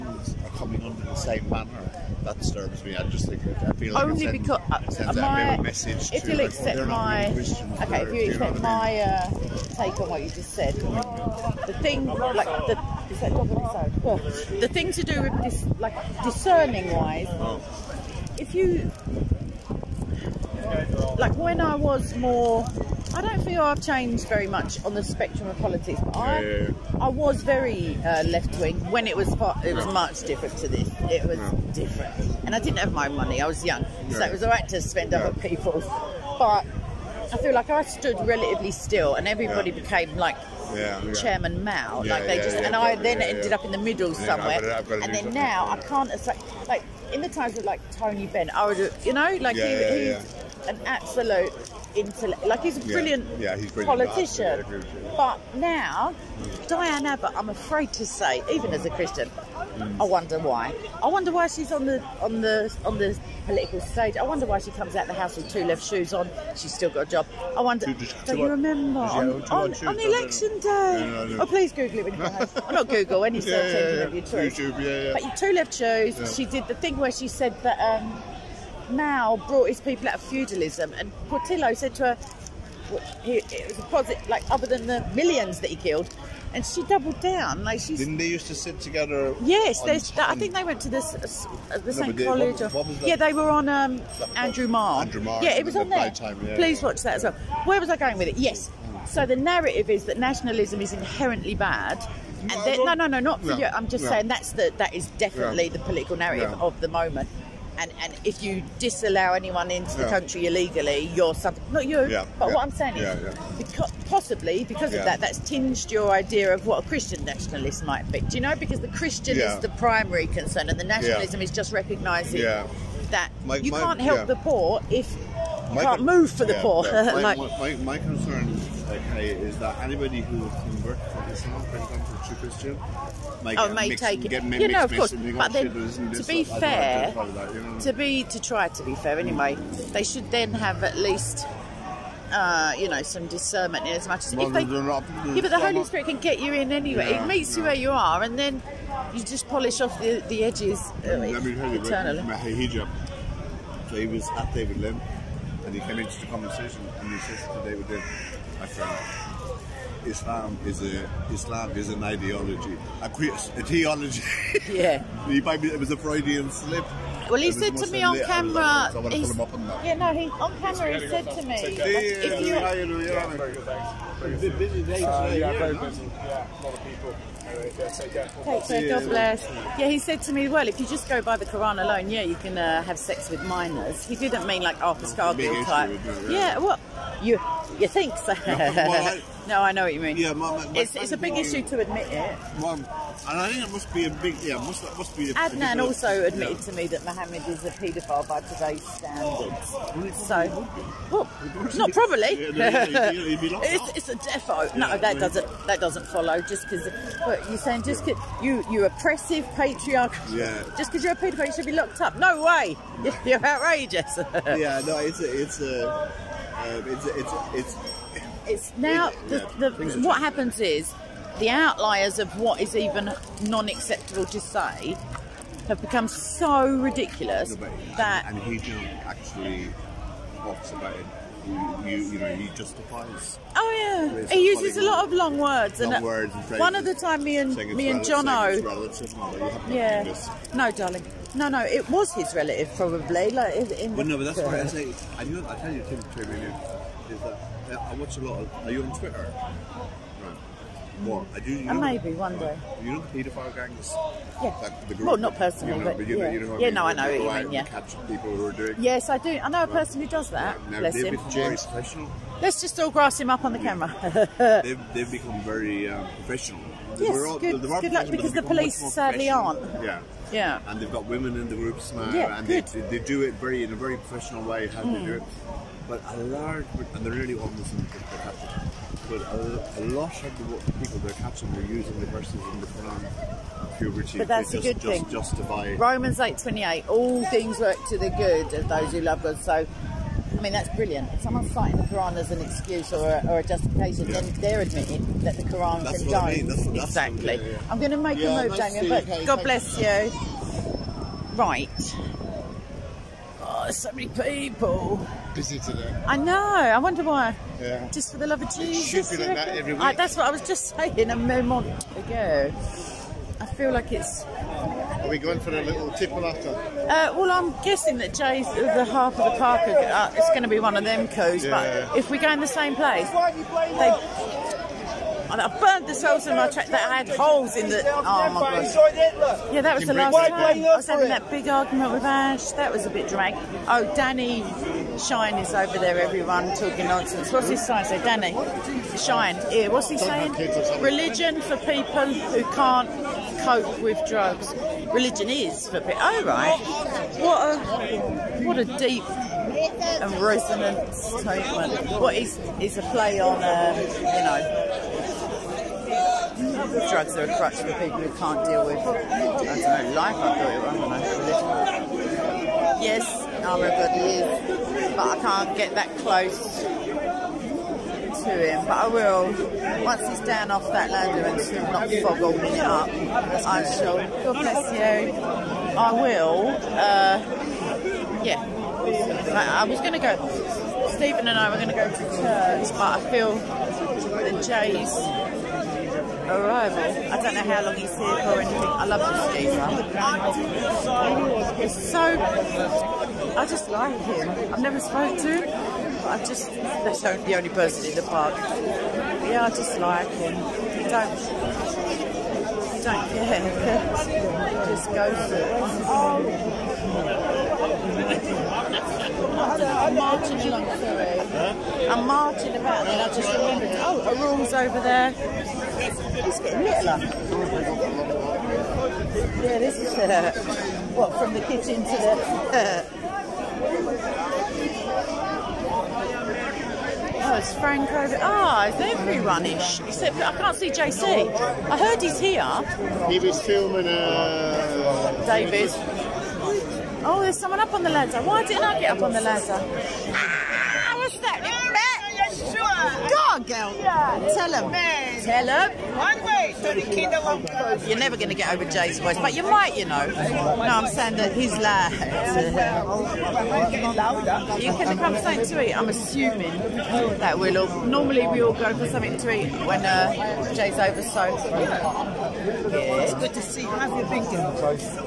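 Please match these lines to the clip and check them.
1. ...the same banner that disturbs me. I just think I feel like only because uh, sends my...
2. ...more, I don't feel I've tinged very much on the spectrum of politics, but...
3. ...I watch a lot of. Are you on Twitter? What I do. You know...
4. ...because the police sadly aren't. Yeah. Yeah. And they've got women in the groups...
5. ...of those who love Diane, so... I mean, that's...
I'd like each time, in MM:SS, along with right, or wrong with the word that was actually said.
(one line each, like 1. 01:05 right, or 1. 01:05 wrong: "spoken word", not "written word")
1. 00:01 right
2. 00:22 wrong: "changed", not "tinged"
3. 04:07 right
4. 04:28 right
5. 04:48 wrong: "God", not "Diane".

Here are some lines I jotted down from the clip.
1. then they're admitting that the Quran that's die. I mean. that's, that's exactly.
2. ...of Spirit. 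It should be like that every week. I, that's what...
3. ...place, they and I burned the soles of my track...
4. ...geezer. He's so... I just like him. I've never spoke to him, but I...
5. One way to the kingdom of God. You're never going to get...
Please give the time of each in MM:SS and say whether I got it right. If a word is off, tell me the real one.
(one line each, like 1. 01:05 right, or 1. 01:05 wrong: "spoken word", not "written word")
1. 04:54 right
2. 05:08 wrong: "Jesus", not "Spirit"
3. 05:22 right
4. 06:29 right
5. 07:25 right.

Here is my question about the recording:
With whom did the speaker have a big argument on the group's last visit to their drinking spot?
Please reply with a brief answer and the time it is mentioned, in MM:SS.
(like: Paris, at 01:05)
Ash, at 05:32.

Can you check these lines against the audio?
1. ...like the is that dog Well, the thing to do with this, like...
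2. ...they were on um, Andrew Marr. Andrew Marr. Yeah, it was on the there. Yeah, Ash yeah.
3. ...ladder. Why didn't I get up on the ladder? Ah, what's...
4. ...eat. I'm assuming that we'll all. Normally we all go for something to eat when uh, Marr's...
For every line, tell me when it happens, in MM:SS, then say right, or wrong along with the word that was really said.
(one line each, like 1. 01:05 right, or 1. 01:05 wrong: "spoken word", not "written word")
1. 00:12 right
2. 01:33 wrong: "Please", not "Ash"
3. 07:17 right
4. 07:35 wrong: "Jay", not "Marr".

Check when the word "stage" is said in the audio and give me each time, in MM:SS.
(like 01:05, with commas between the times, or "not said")
01:03.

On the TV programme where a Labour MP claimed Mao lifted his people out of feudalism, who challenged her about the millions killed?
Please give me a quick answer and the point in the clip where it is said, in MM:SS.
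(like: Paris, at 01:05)
Portillo, at 01:21.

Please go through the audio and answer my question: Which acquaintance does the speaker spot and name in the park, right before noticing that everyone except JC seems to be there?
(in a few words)
Frank.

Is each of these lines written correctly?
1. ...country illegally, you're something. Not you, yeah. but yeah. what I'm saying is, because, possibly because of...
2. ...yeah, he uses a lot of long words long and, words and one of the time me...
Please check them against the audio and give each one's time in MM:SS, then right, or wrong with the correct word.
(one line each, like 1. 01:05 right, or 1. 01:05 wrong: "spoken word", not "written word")
1. 01:50 right
2. 03:54 right.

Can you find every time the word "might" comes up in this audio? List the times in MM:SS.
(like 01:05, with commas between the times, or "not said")
01:57, 02:13, 07:29.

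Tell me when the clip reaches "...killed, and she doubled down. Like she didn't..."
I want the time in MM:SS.
01:25.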